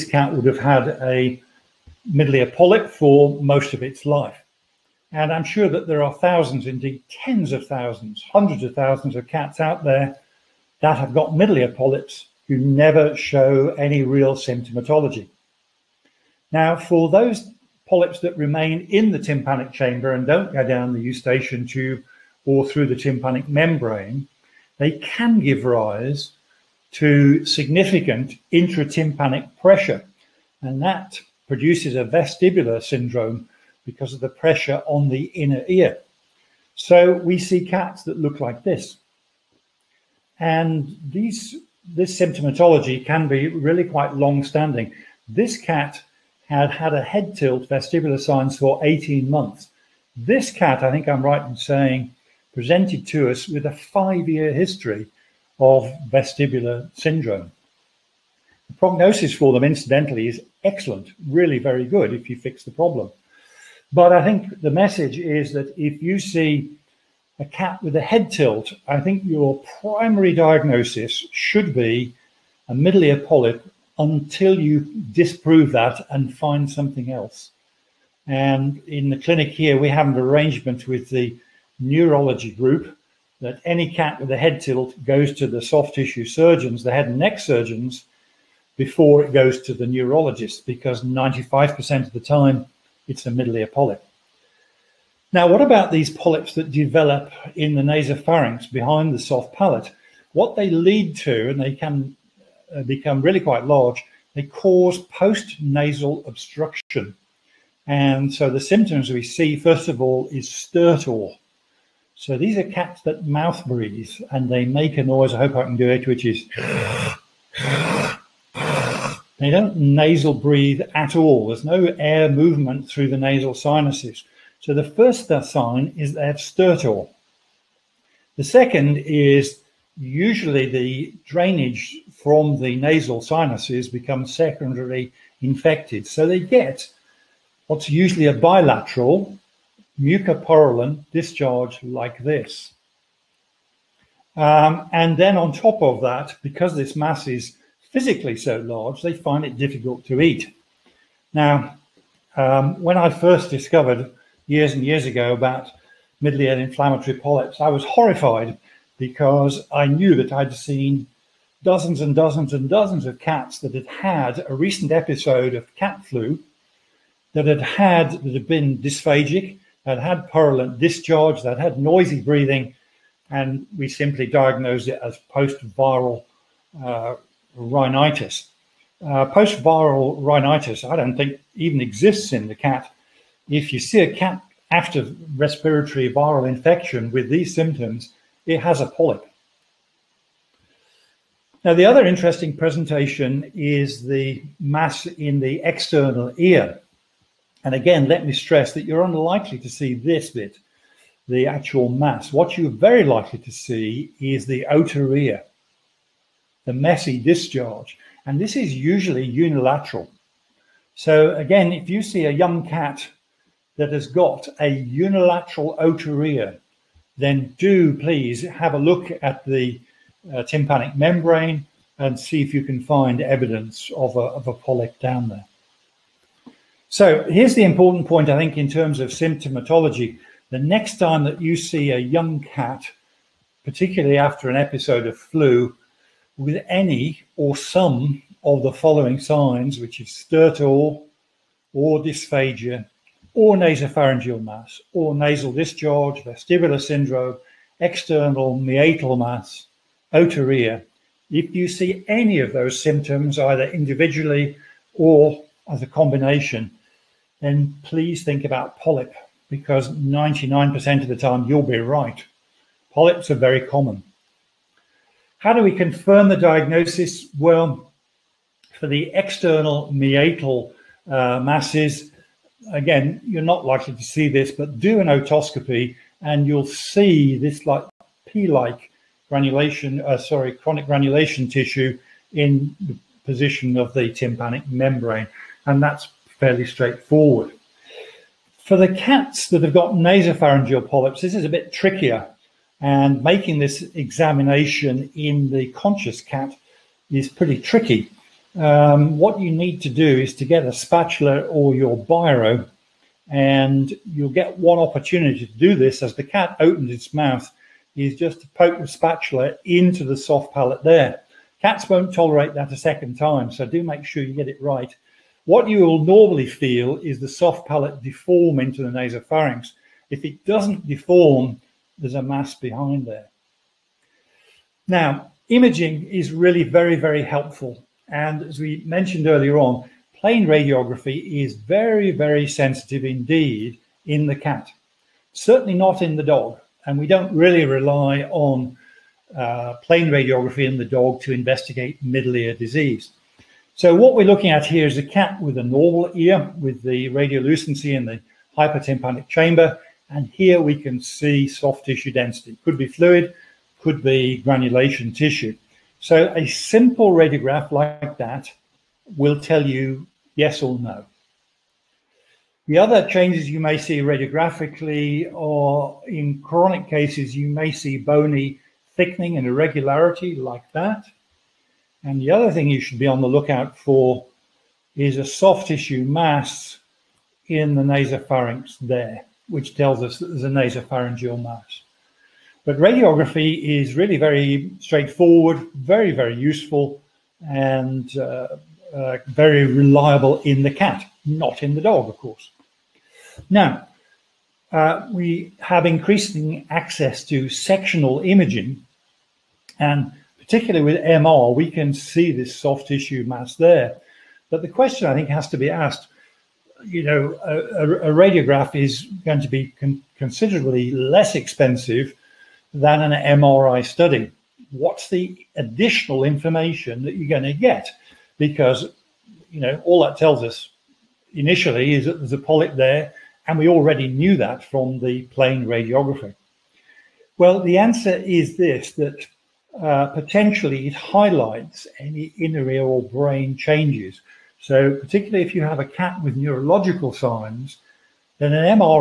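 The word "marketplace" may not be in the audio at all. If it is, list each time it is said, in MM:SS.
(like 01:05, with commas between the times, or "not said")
not said.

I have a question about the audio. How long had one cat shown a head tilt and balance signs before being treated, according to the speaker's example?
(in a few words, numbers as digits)
18 months.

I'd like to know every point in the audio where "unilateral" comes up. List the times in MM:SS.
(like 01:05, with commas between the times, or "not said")
03:29, 03:34.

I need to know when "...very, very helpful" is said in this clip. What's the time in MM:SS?
05:26.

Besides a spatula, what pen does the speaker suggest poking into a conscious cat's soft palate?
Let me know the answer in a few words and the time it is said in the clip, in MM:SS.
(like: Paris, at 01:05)
Biro, at 05:02.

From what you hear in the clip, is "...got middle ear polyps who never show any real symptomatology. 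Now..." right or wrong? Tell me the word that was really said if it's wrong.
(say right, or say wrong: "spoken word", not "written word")
right.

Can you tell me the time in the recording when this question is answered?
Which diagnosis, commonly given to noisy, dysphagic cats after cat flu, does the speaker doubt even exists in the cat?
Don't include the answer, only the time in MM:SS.
02:55.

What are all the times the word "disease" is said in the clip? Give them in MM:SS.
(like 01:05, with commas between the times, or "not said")
05:42.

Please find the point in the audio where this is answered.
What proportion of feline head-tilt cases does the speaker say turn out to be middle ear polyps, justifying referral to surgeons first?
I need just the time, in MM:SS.
01:31.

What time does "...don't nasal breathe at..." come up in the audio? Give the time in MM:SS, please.
01:59.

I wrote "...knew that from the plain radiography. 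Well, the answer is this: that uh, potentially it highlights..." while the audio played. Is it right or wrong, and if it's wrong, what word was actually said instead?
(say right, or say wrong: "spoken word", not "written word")
right.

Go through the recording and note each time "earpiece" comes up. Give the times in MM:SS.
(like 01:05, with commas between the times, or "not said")
not said.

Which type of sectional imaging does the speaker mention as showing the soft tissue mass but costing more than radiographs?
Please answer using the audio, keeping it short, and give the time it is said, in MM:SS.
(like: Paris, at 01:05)
MR, at 06:41.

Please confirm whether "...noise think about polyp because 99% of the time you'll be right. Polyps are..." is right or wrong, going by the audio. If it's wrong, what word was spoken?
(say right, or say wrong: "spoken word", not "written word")
wrong: "please", not "noise".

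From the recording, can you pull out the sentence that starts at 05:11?
Cats won't tolerate that a second time, so do make sure you get it right.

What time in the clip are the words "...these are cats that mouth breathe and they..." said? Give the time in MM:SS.
01:52.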